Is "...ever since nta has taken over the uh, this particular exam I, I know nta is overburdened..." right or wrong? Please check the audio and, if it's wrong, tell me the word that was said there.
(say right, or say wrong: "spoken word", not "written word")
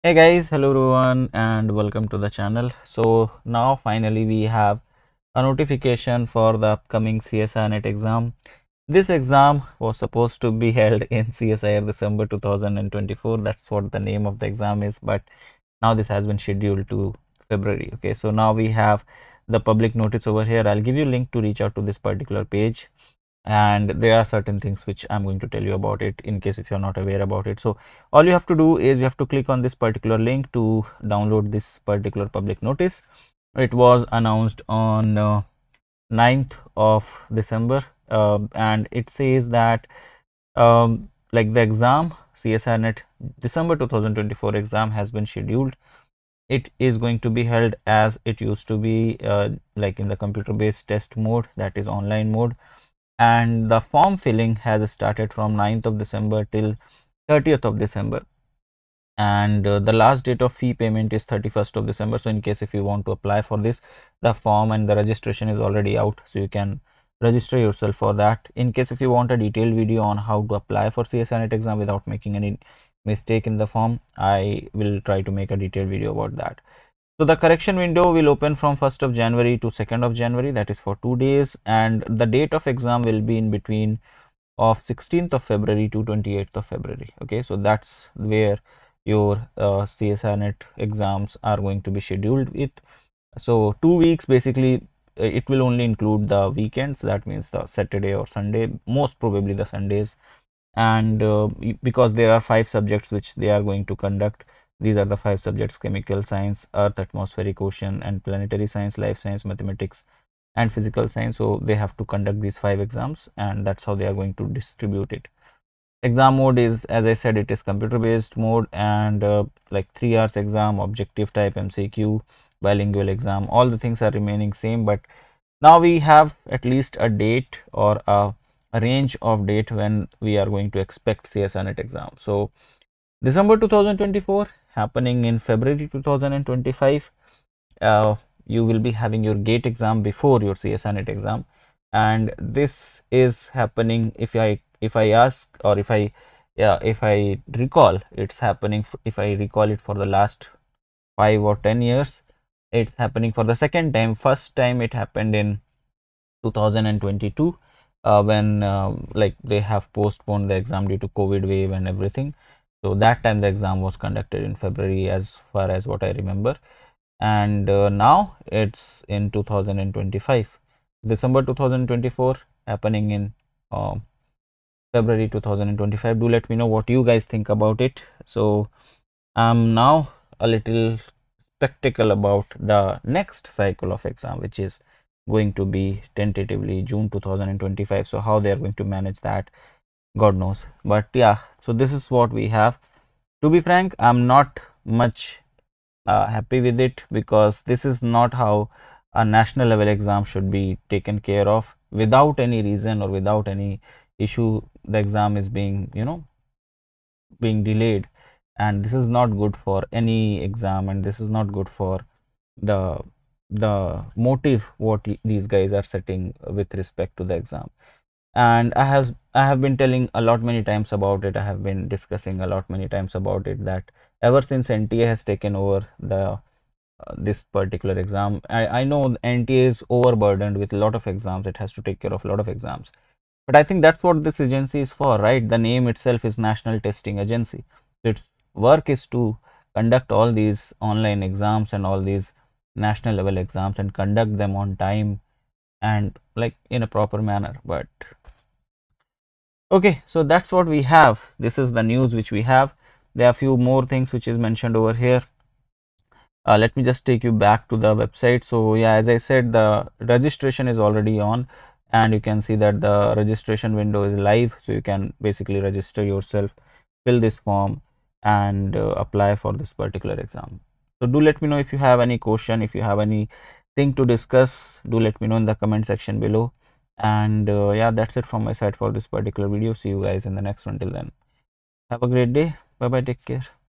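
right.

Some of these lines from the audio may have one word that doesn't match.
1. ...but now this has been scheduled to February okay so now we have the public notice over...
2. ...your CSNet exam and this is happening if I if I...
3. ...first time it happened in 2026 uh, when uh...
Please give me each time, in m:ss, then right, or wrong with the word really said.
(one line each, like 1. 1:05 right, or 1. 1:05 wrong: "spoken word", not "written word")
1. 0:15 right
2. 2:20 right
3. 2:34 wrong: "2022", not "2026".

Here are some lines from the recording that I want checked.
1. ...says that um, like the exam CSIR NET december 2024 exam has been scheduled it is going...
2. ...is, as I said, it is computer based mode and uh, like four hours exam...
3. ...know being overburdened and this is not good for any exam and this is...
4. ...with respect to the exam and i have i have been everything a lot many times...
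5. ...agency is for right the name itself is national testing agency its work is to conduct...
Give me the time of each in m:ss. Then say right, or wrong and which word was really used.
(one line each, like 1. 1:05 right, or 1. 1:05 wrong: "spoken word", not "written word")
1. 0:39 right
2. 1:56 wrong: "three", not "four"
3. 3:26 wrong: "delayed", not "overburdened"
4. 3:36 wrong: "telling", not "everything"
5. 3:54 right.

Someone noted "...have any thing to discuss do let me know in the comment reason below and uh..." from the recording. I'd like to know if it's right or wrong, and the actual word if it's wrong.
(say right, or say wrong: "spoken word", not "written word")
wrong: "section", not "reason".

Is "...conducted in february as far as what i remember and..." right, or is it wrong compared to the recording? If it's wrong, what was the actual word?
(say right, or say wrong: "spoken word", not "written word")
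right.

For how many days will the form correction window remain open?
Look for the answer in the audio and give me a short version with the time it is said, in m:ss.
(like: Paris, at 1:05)
2 days, at 1:21.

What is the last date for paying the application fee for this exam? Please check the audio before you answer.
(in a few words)
31st of December.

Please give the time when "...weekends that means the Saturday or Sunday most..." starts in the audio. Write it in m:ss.
1:36.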